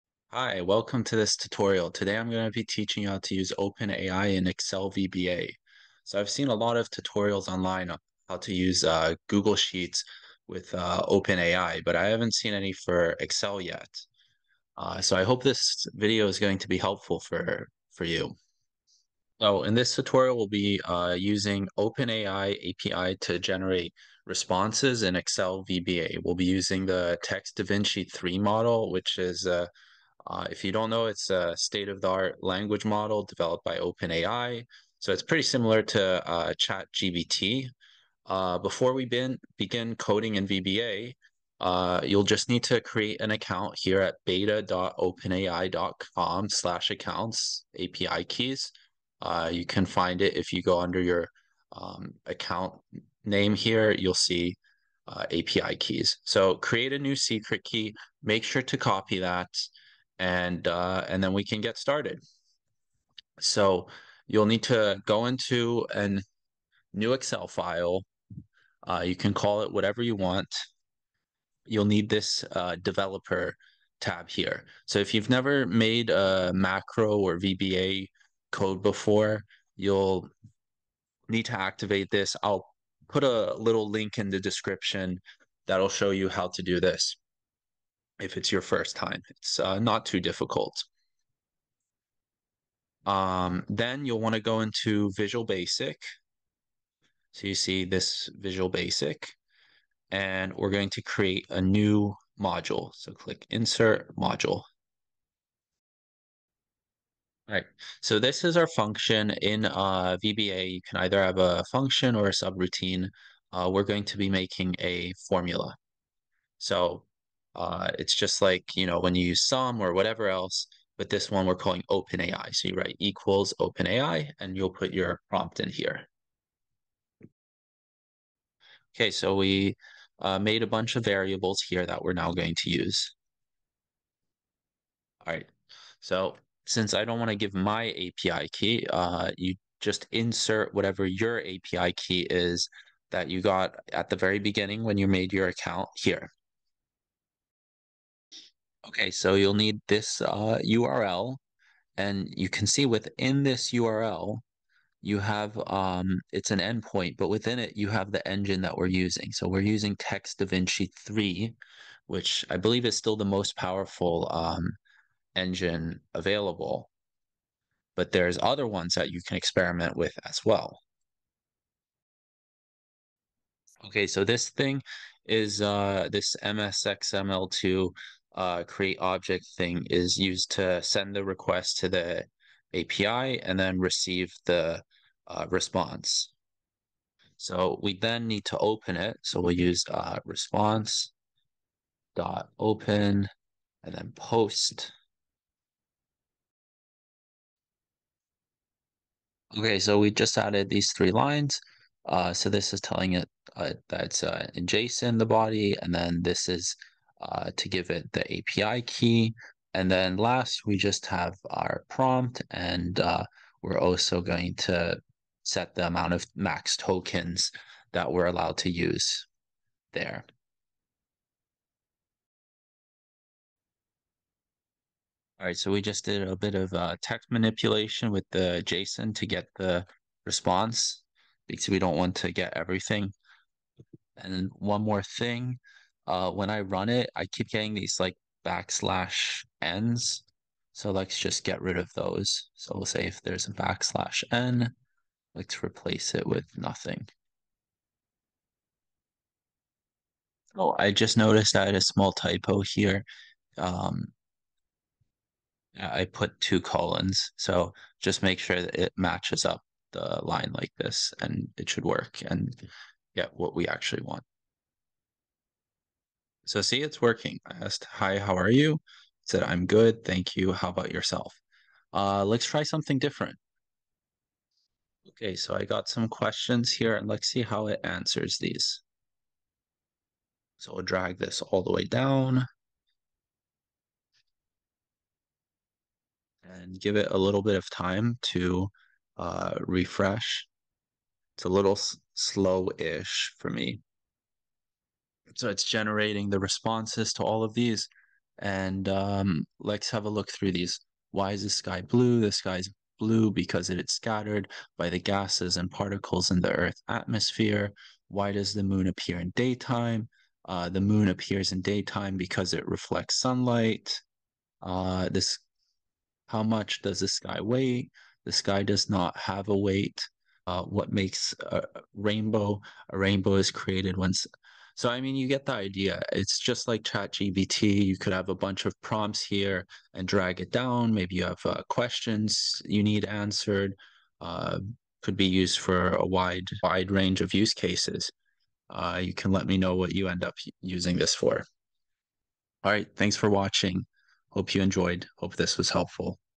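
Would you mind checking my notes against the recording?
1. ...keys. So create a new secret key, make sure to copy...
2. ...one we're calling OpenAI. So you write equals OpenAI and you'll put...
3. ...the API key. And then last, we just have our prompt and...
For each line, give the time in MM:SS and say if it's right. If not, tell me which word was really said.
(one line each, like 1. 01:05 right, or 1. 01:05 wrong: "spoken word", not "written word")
1. 00:55 right
2. 02:01 right
3. 03:28 right.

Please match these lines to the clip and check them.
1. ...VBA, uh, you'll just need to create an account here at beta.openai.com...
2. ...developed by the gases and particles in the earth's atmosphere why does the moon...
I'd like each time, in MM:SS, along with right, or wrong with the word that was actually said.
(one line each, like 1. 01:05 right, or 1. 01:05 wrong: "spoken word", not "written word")
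1. 00:40 right
2. 05:03 wrong: "scattered", not "developed".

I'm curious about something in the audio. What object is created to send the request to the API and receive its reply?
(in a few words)
MSXML2.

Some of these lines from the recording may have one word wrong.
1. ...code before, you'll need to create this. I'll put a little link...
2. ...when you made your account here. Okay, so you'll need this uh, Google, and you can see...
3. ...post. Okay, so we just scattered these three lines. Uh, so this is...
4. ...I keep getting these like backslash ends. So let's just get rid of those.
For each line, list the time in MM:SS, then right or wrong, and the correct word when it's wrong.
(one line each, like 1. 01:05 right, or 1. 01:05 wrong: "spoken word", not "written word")
1. 01:18 wrong: "activate", not "create"
2. 02:24 wrong: "URL", not "Google"
3. 03:14 wrong: "added", not "scattered"
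4. 03:57 right.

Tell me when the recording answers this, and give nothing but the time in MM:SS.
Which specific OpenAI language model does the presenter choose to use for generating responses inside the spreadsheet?
00:27.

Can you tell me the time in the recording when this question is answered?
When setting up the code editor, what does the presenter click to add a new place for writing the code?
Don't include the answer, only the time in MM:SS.
01:43.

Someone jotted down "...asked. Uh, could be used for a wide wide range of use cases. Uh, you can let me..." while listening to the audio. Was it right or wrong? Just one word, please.
wrong.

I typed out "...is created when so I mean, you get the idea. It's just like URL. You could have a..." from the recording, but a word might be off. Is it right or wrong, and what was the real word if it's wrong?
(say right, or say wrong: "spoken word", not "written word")
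wrong: "ChatGPT", not "URL".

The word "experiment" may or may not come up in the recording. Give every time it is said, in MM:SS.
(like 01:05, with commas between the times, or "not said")
02:49.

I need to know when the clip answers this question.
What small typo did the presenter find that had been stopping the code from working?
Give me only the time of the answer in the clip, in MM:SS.
04:16.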